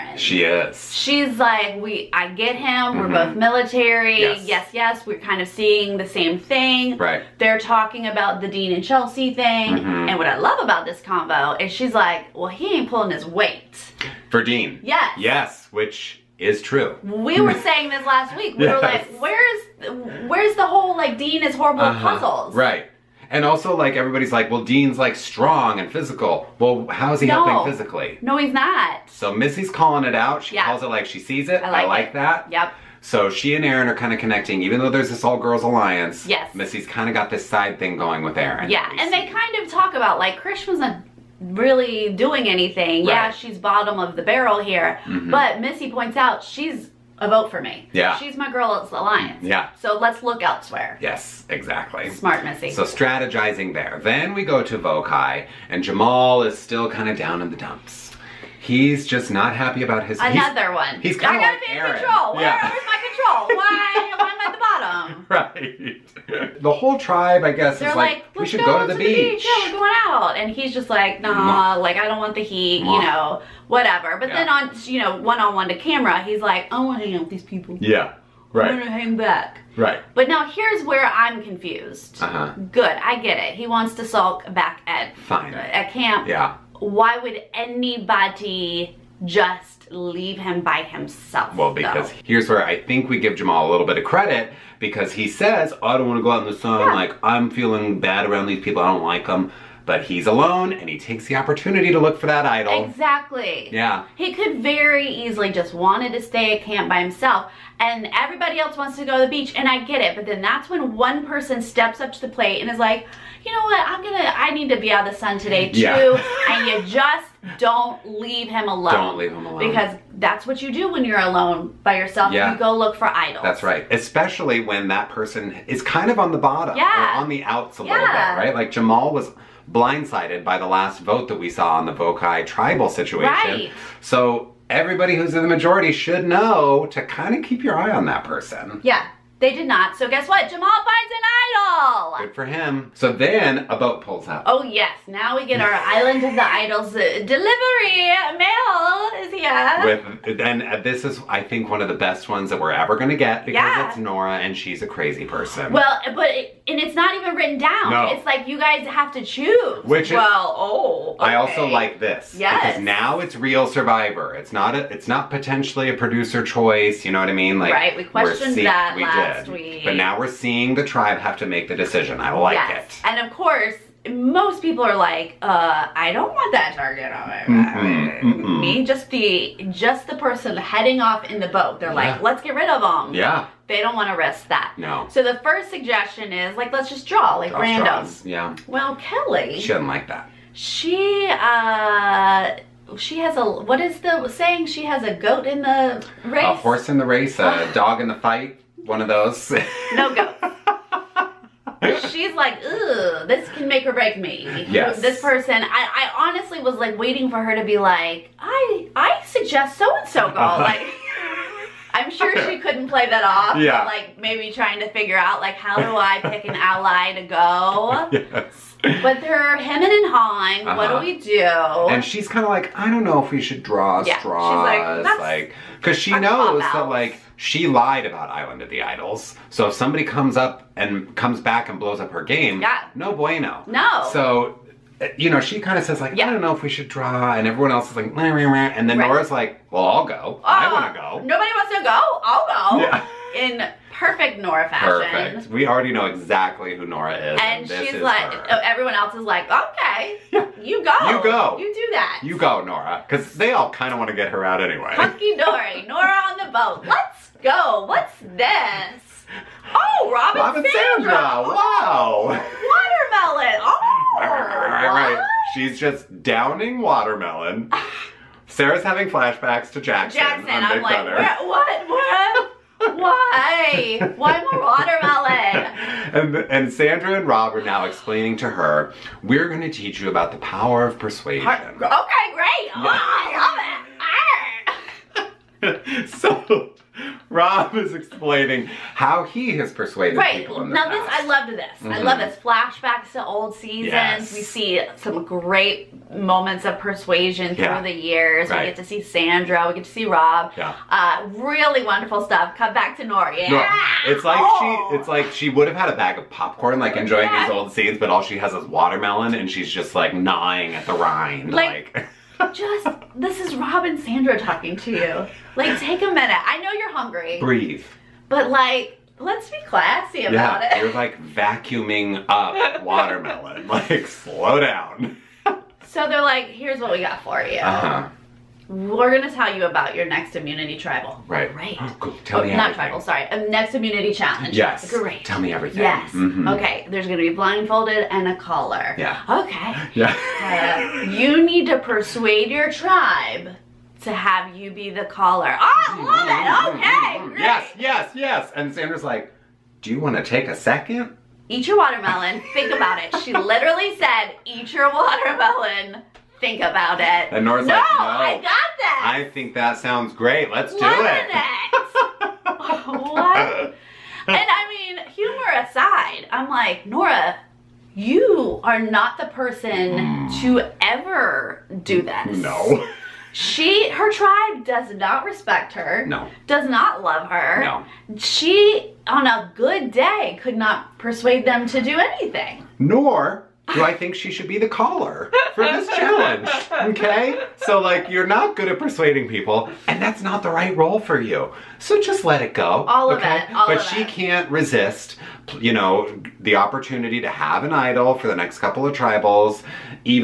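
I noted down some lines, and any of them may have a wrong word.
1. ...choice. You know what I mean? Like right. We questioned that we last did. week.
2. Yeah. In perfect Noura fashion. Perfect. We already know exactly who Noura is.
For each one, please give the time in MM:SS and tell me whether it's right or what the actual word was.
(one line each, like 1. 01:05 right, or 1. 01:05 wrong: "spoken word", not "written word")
1. 02:46 right
2. 04:02 right.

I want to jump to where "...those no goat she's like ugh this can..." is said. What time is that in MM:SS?
03:19.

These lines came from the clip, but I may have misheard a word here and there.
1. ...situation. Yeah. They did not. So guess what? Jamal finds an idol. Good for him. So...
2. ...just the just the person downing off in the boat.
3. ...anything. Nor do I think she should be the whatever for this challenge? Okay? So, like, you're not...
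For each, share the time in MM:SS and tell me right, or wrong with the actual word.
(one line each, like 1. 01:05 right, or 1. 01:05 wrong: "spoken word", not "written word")
1. 02:18 wrong: "person", not "situation"
2. 02:58 wrong: "heading", not "downing"
3. 06:21 wrong: "caller", not "whatever".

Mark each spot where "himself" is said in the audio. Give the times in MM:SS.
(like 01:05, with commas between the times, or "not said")
01:30, 01:47.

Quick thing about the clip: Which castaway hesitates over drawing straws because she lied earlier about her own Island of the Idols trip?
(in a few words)
Kellee.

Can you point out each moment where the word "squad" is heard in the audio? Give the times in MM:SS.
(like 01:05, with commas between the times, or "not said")
not said.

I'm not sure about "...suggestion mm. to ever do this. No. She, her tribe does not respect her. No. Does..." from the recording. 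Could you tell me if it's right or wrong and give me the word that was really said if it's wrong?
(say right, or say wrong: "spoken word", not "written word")
wrong: "person", not "suggestion".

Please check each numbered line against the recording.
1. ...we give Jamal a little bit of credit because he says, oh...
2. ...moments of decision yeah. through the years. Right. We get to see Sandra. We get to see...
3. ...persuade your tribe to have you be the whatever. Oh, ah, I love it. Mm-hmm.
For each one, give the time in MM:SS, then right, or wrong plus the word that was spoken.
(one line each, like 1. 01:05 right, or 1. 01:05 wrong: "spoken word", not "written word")
1. 01:33 right
2. 04:56 wrong: "persuasion", not "decision"
3. 05:41 wrong: "caller", not "whatever".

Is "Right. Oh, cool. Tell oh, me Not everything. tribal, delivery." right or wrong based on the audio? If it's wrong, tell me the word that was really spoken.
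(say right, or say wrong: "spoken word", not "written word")
wrong: "sorry", not "delivery".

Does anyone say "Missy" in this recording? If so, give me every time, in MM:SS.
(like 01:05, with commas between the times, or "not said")
00:29, 00:36, 00:45, 00:52.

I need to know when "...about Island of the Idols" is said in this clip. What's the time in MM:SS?
03:48.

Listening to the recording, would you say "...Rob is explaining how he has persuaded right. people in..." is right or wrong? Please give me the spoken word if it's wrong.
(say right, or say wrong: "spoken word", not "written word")
right.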